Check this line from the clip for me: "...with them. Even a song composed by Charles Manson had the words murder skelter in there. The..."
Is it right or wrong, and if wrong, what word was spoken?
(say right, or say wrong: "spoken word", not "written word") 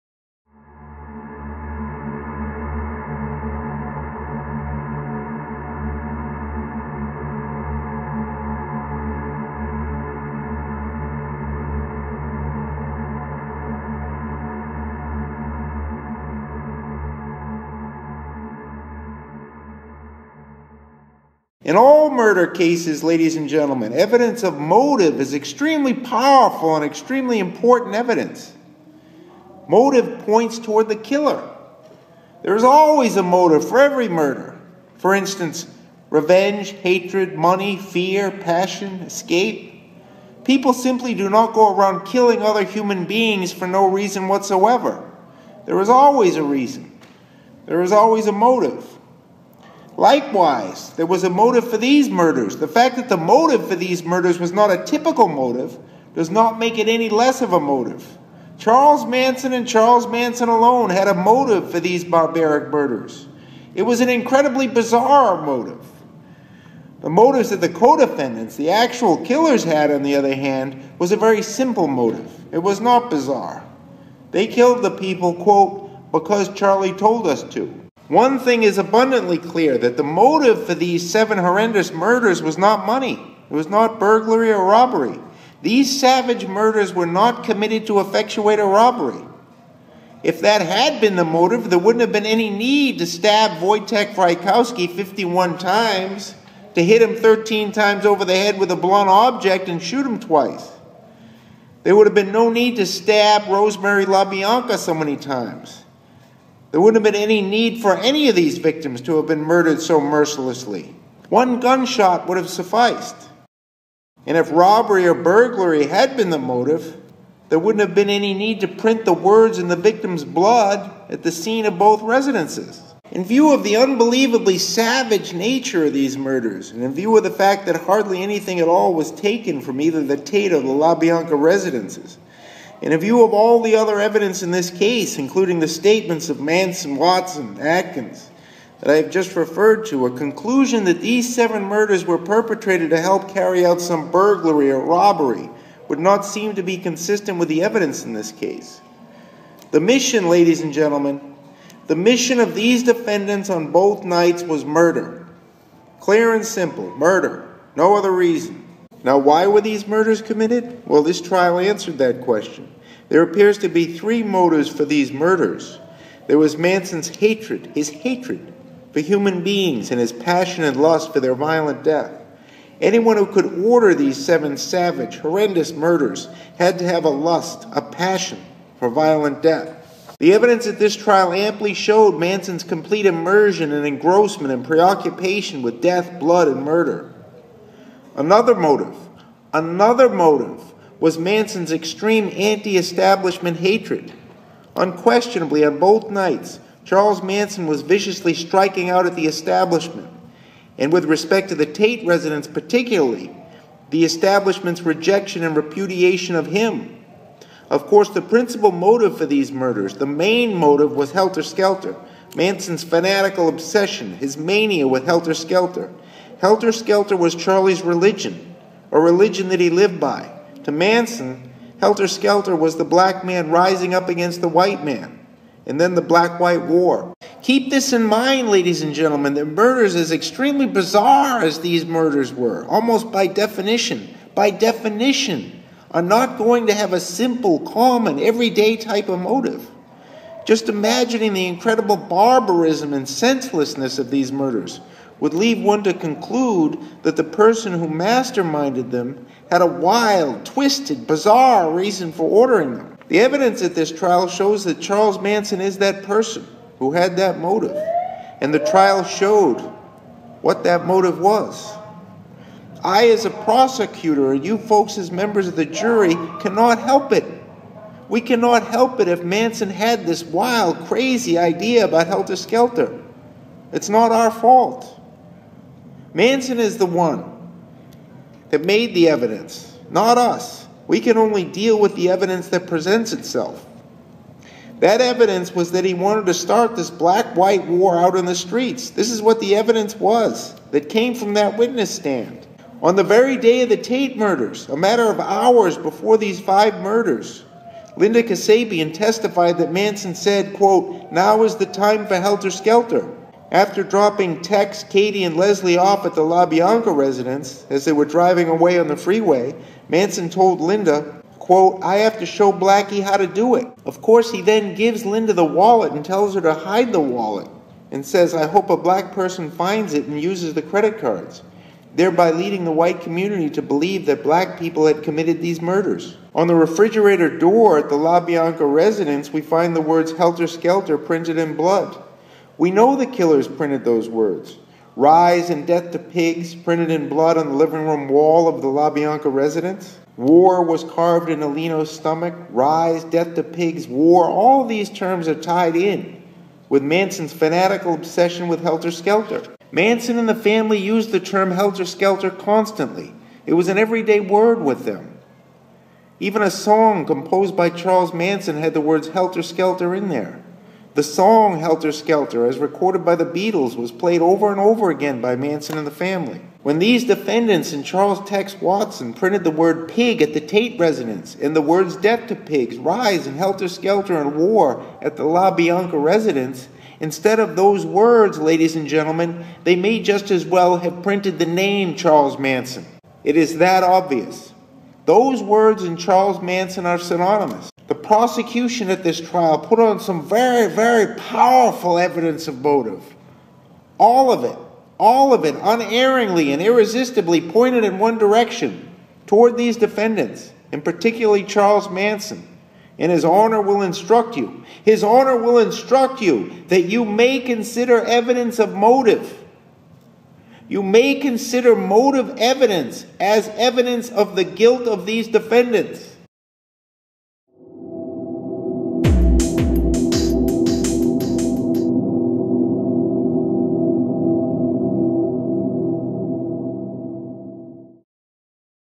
wrong: "helter", not "murder".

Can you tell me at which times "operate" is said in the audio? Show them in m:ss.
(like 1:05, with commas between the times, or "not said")
not said.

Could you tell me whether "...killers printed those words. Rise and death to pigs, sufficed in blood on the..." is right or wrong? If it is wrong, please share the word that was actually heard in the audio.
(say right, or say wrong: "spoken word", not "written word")
wrong: "printed", not "sufficed".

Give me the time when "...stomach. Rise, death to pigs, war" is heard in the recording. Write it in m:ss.
5:41.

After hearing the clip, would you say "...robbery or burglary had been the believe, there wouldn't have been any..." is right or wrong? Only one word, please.
wrong.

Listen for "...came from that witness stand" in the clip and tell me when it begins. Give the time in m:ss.
4:50.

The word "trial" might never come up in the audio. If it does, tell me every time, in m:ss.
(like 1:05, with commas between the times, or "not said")
2:41, 3:00, 4:13, 4:18, 6:29.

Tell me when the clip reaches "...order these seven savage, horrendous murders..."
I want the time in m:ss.
2:53.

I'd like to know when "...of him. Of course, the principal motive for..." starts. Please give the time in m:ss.
3:26.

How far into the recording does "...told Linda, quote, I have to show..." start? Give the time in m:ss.
5:10.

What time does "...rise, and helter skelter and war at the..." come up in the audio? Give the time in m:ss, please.
6:12.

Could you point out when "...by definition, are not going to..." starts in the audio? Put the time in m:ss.
3:54.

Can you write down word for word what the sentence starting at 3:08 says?
Another motive, another motive was Manson's extreme anti establishment hatred.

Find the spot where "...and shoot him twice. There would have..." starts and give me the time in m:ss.
1:39.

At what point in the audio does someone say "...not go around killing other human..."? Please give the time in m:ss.
0:41.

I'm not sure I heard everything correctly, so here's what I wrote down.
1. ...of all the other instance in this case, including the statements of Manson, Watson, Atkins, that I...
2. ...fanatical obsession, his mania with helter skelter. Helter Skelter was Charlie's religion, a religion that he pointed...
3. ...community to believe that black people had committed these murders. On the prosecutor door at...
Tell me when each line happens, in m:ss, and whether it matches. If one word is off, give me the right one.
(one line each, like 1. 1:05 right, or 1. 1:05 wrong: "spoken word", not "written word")
1. 2:13 wrong: "evidence", not "instance"
2. 3:32 wrong: "lived", not "pointed"
3. 5:23 wrong: "refrigerator", not "prosecutor".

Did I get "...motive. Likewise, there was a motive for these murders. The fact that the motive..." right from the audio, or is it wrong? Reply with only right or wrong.
right.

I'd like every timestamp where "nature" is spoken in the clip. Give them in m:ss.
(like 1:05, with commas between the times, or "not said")
2:05.